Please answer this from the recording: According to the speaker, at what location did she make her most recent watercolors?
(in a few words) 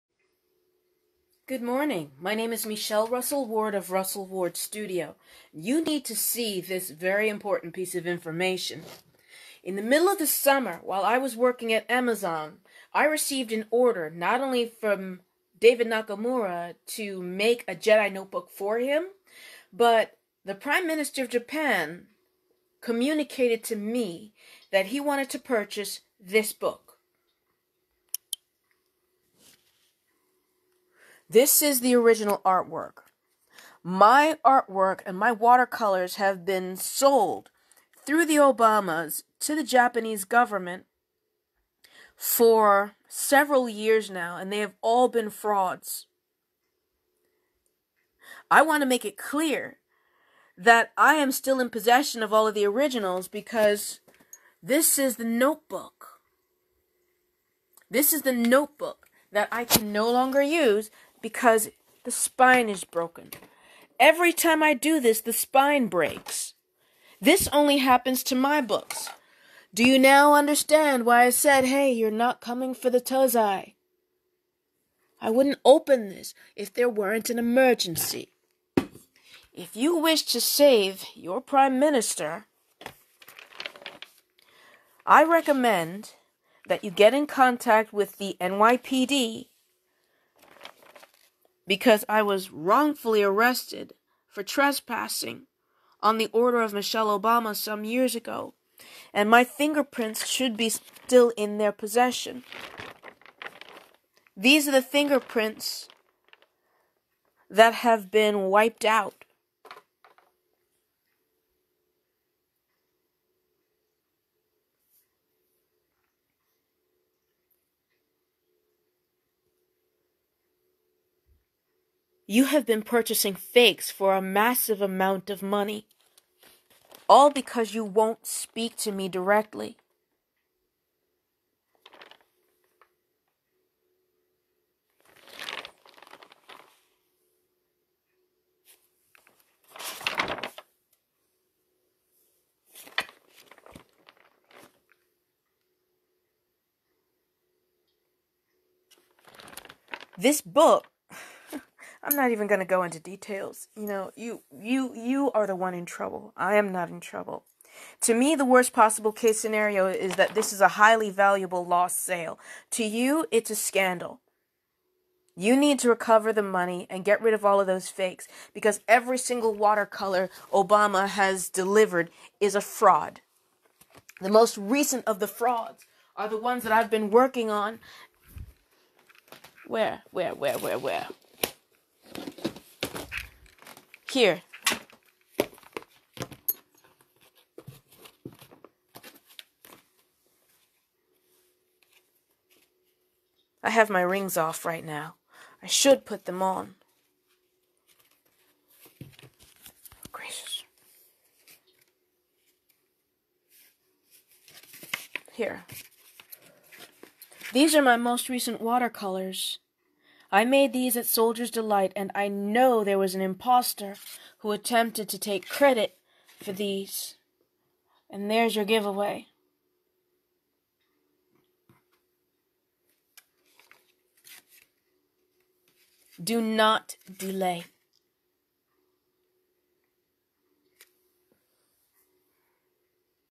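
Soldier's Delight.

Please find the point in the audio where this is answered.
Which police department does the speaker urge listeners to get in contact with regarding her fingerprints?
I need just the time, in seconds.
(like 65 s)
88 s.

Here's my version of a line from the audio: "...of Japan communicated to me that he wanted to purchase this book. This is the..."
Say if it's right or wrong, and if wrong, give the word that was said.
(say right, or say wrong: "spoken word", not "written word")
right.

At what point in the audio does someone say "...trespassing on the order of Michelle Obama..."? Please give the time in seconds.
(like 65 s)
94 s.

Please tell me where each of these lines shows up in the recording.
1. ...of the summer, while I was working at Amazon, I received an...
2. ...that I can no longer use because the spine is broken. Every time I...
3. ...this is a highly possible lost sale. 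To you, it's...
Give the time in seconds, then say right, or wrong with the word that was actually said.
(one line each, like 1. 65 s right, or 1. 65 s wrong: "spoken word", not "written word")
1. 10 s right
2. 59 s right
3. 160 s wrong: "valuable", not "possible".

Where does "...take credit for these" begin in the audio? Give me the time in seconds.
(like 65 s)
215 s.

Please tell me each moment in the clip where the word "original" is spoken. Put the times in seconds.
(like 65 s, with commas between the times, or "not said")
31 s, 52 s.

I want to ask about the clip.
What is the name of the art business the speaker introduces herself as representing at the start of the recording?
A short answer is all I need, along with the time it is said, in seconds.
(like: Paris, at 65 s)
Russell Ward Studio, at 3 s.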